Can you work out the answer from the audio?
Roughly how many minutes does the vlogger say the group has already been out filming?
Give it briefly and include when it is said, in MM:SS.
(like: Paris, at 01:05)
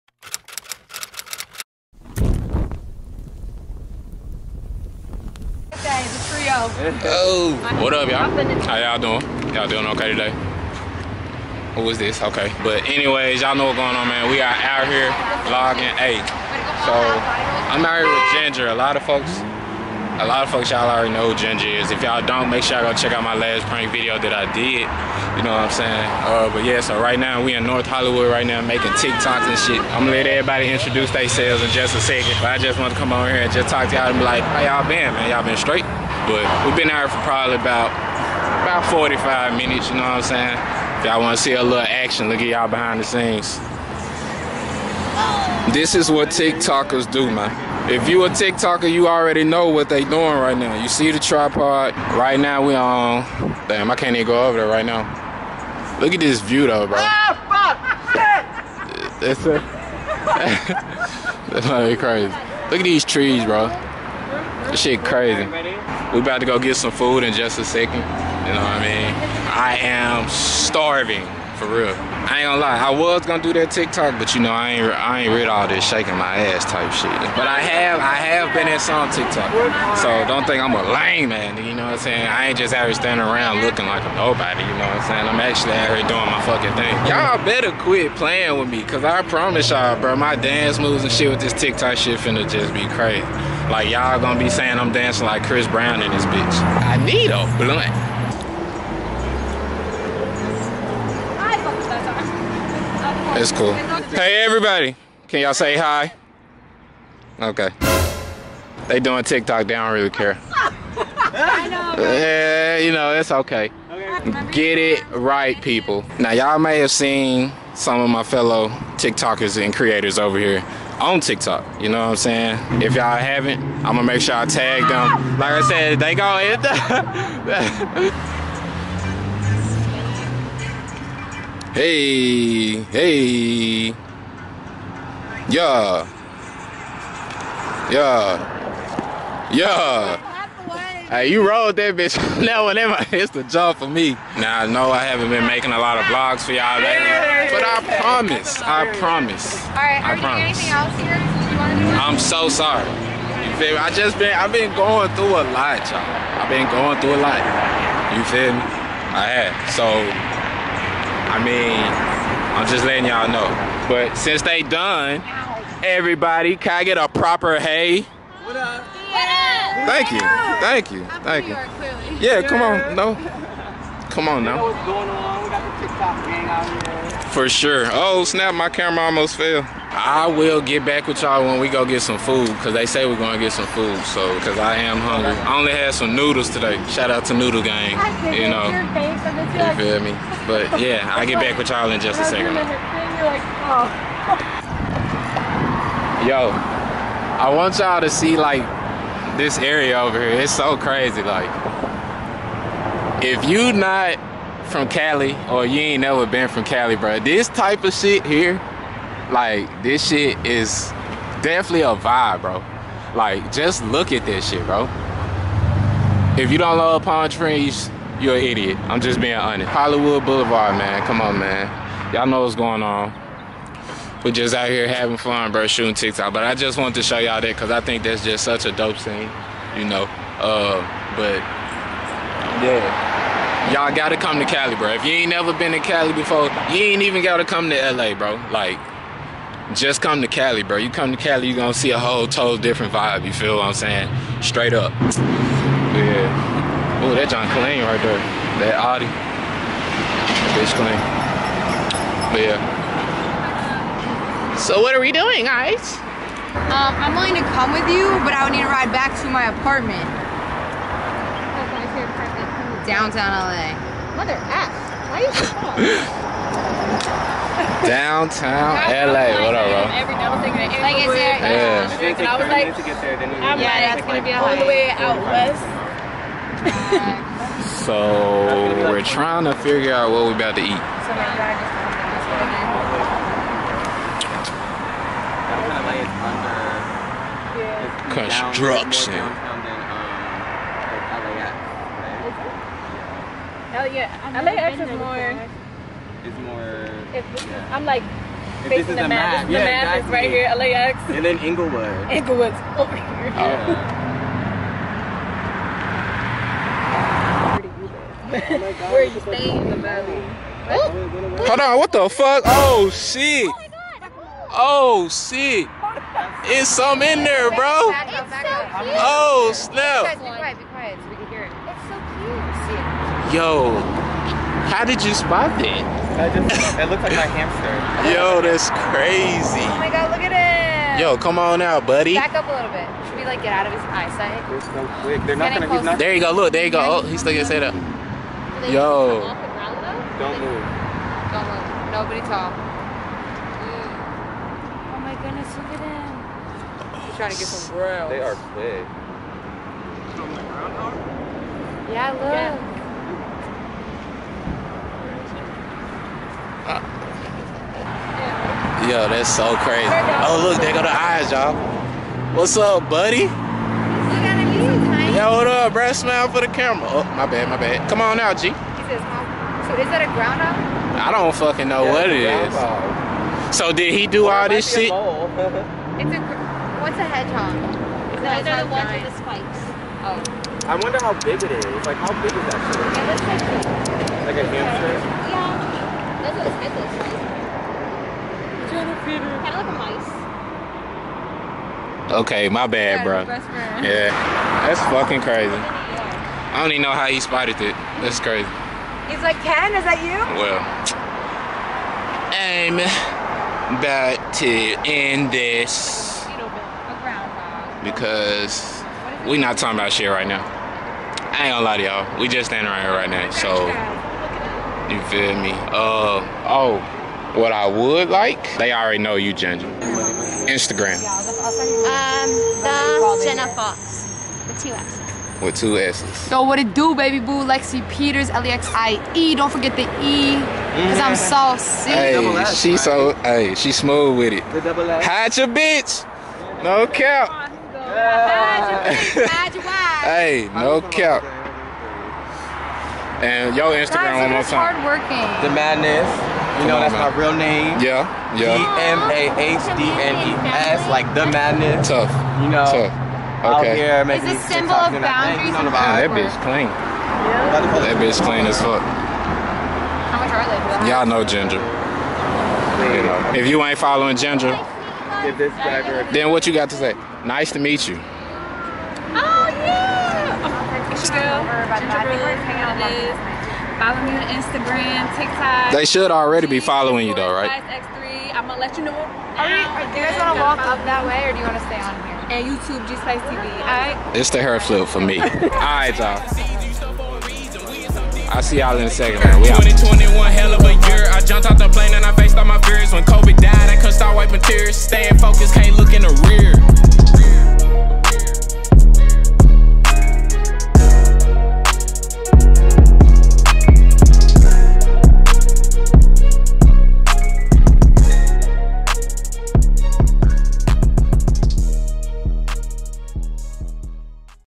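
45, at 00:38.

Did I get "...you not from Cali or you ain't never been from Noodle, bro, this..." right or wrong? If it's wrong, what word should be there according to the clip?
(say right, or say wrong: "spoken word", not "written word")
wrong: "Cali", not "Noodle".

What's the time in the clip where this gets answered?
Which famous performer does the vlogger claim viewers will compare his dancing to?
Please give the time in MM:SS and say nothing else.
01:35.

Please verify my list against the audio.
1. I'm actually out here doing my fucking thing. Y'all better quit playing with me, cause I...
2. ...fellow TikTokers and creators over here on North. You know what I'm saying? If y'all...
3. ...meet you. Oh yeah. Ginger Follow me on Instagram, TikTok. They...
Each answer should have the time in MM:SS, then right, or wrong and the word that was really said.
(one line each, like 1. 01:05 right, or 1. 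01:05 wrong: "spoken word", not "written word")
1. 01:25 right
2. 01:58 wrong: "TikTok", not "North"
3. 07:47 right.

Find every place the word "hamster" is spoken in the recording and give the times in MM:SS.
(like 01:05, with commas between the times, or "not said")
05:27, 06:24.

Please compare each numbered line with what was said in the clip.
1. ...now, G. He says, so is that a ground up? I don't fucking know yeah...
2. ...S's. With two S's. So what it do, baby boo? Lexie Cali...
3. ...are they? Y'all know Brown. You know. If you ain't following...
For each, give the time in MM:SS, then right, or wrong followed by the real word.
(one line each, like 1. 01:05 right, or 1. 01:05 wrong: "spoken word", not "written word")
1. 06:08 right
2. 07:04 wrong: "Peters", not "Cali"
3. 07:40 wrong: "Ginger", not "Brown".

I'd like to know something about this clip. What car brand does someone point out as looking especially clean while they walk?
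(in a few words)
Audi.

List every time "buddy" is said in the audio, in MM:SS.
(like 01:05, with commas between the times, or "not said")
05:31, 06:02.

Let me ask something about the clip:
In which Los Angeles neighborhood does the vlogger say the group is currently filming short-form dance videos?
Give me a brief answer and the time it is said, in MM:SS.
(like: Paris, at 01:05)
North Hollywood, at 00:27.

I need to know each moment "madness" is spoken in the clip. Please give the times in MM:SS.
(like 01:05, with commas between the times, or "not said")
07:25, 07:31.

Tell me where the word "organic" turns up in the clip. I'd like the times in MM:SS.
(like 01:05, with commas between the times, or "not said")
not said.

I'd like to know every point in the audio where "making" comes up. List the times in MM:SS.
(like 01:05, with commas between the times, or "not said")
00:28, 02:25.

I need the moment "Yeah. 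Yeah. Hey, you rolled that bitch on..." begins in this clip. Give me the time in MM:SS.
02:17.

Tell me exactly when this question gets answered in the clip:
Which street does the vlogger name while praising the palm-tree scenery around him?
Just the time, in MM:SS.
03:39.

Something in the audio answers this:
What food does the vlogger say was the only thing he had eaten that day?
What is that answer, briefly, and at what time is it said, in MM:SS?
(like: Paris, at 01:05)
Noodles, at 03:06.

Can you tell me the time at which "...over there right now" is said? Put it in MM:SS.
00:54.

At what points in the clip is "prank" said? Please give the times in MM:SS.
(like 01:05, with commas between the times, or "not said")
00:23.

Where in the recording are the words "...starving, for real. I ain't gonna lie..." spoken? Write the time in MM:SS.
01:10.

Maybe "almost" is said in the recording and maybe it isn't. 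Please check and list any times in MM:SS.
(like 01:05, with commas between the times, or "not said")
02:59.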